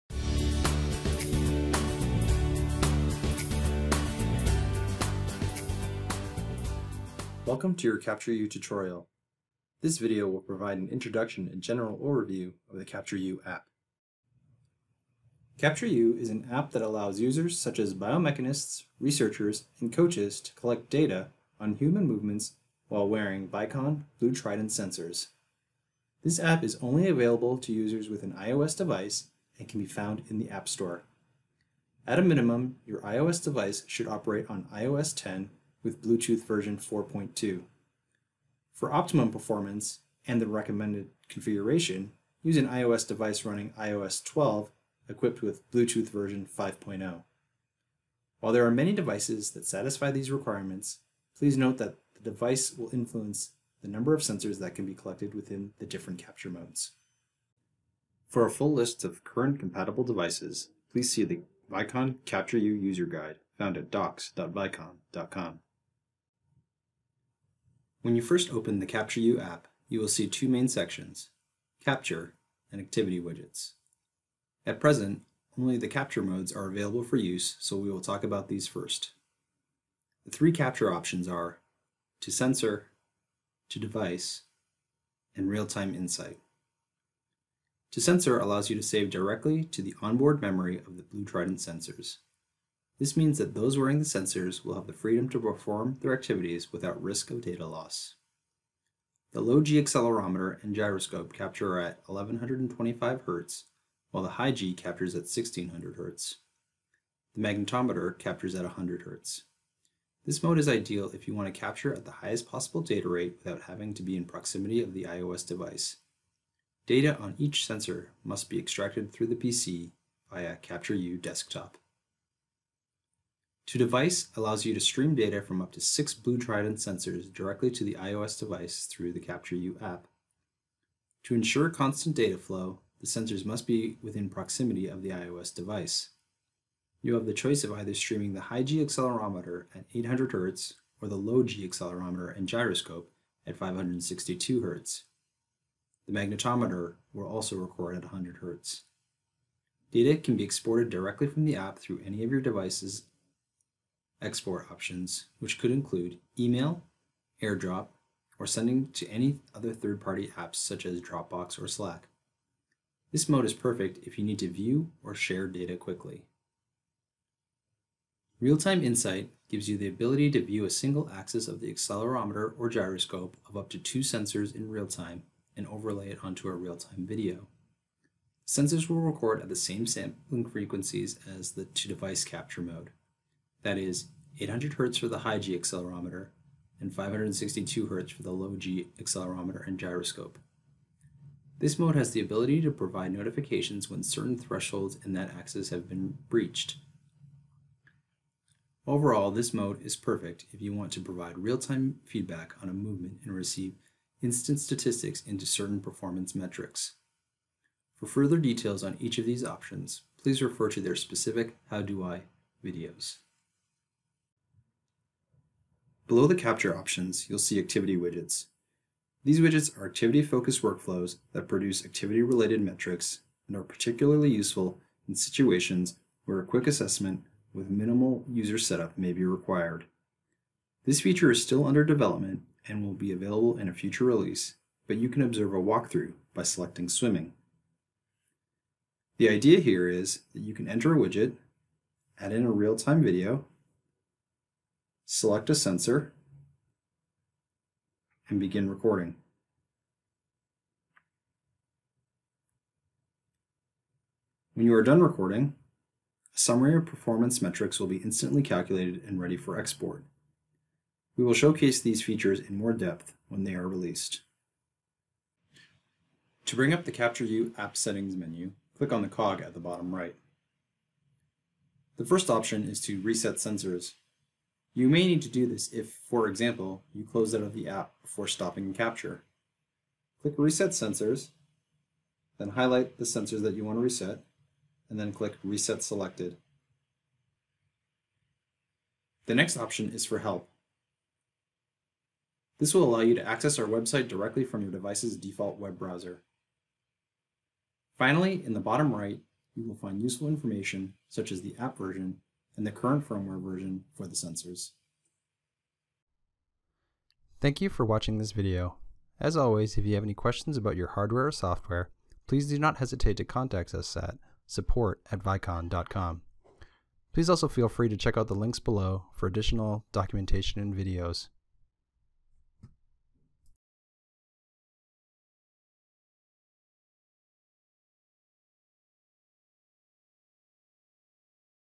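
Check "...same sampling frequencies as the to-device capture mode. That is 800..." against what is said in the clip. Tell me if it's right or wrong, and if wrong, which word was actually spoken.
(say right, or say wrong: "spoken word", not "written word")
right.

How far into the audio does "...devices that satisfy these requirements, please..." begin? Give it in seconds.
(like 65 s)
48 s.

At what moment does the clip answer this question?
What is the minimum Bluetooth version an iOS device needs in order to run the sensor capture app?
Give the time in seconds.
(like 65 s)
36 s.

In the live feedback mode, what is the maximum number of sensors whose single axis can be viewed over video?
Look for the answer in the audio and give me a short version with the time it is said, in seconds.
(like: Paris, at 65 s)
2, at 173 s.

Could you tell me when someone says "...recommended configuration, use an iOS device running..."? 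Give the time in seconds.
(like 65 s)
40 s.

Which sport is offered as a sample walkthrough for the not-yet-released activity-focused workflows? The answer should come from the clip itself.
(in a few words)
Swimming.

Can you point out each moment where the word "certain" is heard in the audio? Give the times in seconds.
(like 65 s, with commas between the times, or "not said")
194 s, 205 s.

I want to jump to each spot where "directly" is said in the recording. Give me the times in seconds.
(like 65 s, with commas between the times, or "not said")
89 s, 127 s, 150 s, 294 s.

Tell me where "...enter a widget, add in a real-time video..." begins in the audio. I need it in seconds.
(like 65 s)
240 s.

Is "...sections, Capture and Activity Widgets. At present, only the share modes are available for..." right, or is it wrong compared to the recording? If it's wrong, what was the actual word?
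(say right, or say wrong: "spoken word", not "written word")
wrong: "capture", not "share".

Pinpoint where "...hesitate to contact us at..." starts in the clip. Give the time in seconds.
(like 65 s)
312 s.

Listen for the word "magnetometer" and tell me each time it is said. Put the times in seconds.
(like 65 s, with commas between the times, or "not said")
107 s, 146 s.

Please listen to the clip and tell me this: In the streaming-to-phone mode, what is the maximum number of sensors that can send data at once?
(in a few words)
6.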